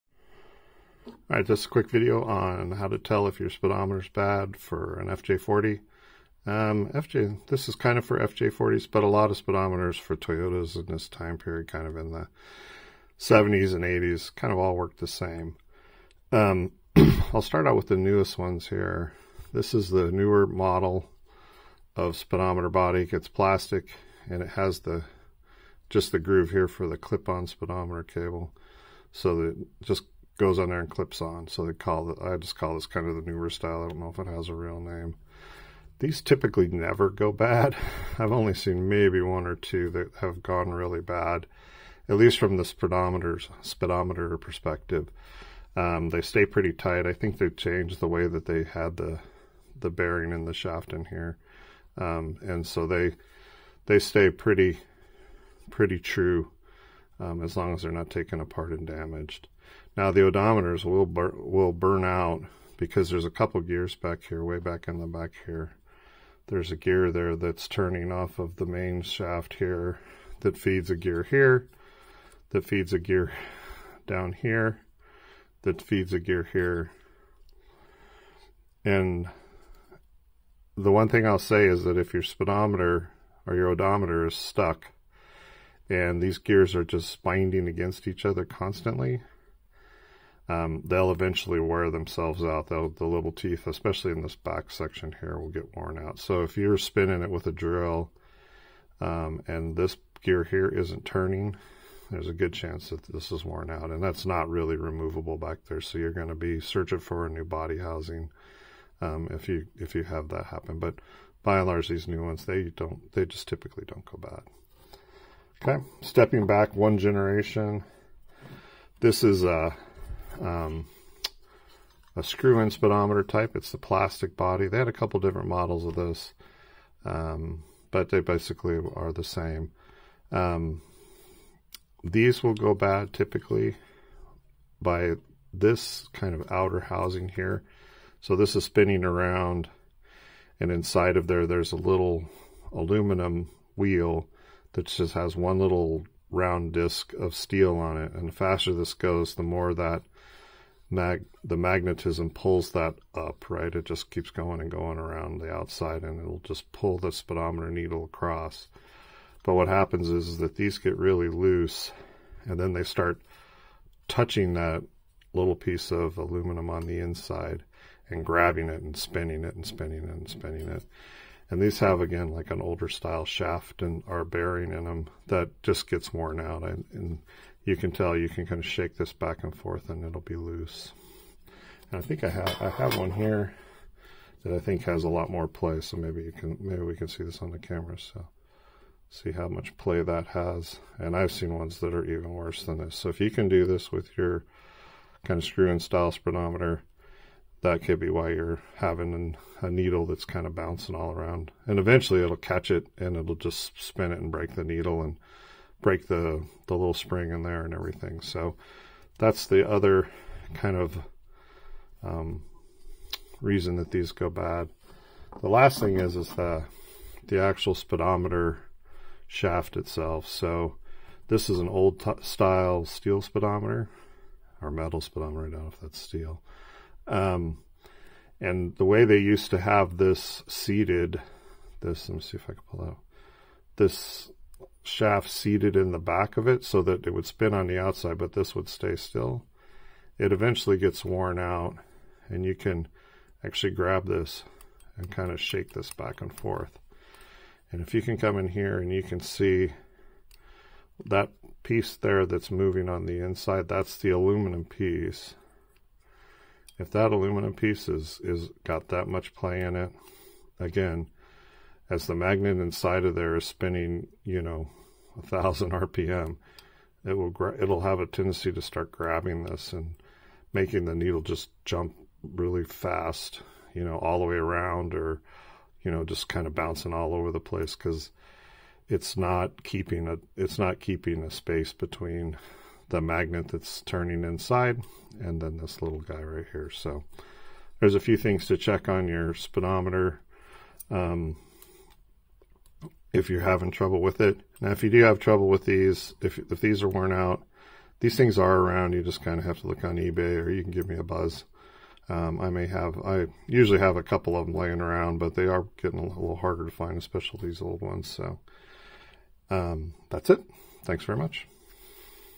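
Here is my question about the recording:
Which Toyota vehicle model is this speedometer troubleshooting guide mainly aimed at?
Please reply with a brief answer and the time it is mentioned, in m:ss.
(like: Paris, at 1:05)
FJ40, at 0:05.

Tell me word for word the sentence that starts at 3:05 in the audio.
So maybe you can, maybe we can see this on the camera.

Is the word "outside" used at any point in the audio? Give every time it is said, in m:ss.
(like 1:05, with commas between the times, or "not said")
2:35, 3:57.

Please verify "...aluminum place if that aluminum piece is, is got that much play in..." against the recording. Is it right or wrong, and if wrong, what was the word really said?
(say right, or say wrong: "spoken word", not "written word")
wrong: "piece", not "place".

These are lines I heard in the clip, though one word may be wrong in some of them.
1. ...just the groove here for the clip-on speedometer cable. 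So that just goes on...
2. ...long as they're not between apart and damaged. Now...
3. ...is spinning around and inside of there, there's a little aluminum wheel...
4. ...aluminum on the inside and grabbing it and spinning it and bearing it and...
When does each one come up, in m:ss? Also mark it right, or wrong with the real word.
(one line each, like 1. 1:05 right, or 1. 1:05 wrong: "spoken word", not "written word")
1. 0:25 right
2. 0:57 wrong: "taken", not "between"
3. 2:18 right
4. 2:46 wrong: "spinning", not "bearing".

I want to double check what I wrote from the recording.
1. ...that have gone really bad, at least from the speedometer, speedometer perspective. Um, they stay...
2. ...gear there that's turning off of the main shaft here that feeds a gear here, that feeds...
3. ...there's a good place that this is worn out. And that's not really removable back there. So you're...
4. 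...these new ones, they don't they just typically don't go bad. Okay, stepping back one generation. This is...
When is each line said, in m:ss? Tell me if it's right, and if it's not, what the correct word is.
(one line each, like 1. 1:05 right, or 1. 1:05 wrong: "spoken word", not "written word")
1. 0:39 right
2. 1:06 right
3. 1:42 wrong: "chance", not "place"
4. 1:51 right.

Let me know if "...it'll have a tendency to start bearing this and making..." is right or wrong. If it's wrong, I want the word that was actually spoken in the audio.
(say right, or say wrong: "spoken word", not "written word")
wrong: "grabbing", not "bearing".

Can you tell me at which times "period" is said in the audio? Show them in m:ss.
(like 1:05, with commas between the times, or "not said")
0:11.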